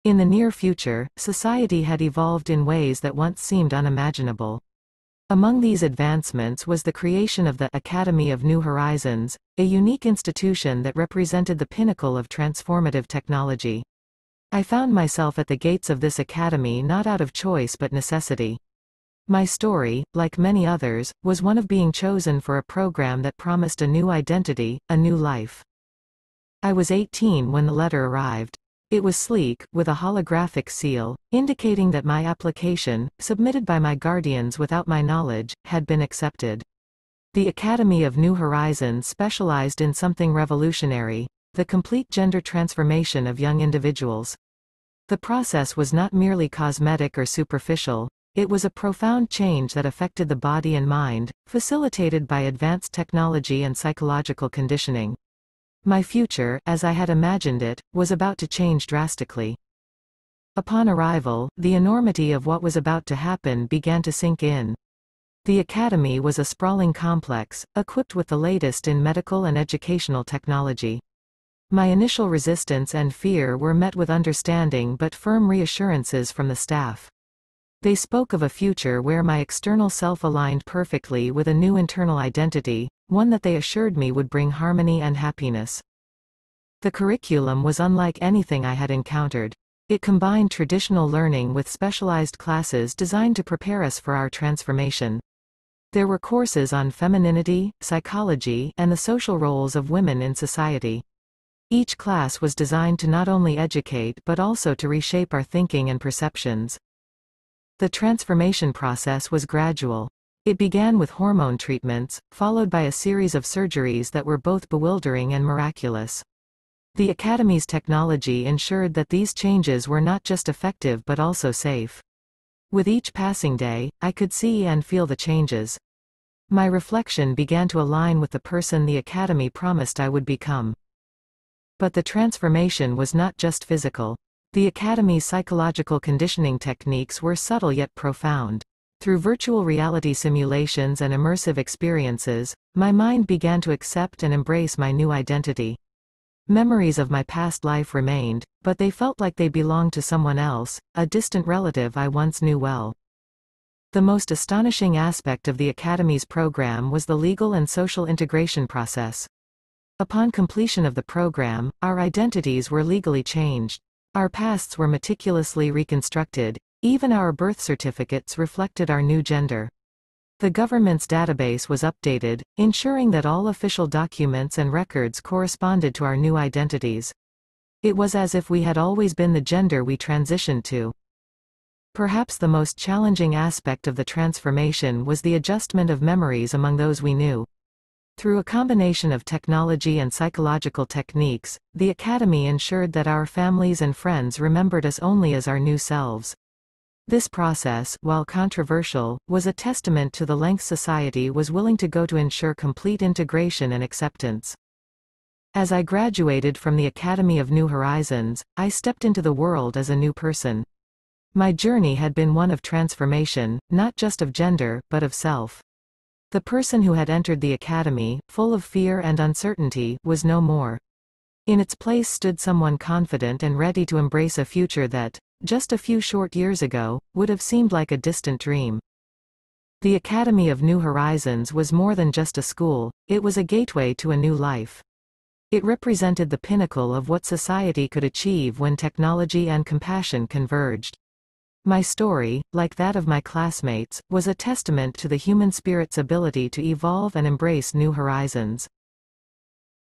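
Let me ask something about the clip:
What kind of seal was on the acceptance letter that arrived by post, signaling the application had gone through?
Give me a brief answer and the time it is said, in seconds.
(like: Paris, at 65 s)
Holographic, at 30 s.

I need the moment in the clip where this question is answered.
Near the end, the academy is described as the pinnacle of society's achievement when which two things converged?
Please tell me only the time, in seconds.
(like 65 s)
238 s.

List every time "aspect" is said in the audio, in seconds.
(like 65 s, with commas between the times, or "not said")
154 s, 183 s.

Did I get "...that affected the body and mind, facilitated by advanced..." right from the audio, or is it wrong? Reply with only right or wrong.
right.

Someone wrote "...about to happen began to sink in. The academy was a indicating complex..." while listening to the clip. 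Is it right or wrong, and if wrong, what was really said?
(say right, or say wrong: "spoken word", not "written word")
wrong: "sprawling", not "indicating".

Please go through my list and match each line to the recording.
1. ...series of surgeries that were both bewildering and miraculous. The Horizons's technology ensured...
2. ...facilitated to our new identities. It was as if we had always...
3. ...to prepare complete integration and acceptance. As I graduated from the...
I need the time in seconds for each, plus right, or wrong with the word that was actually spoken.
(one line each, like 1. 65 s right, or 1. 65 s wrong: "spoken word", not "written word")
1. 112 s wrong: "Academy", not "Horizons"
2. 175 s wrong: "corresponded", not "facilitated"
3. 202 s wrong: "ensure", not "prepare".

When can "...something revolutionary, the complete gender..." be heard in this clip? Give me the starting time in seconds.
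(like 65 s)
39 s.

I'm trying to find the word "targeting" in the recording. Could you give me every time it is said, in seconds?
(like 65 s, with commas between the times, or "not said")
not said.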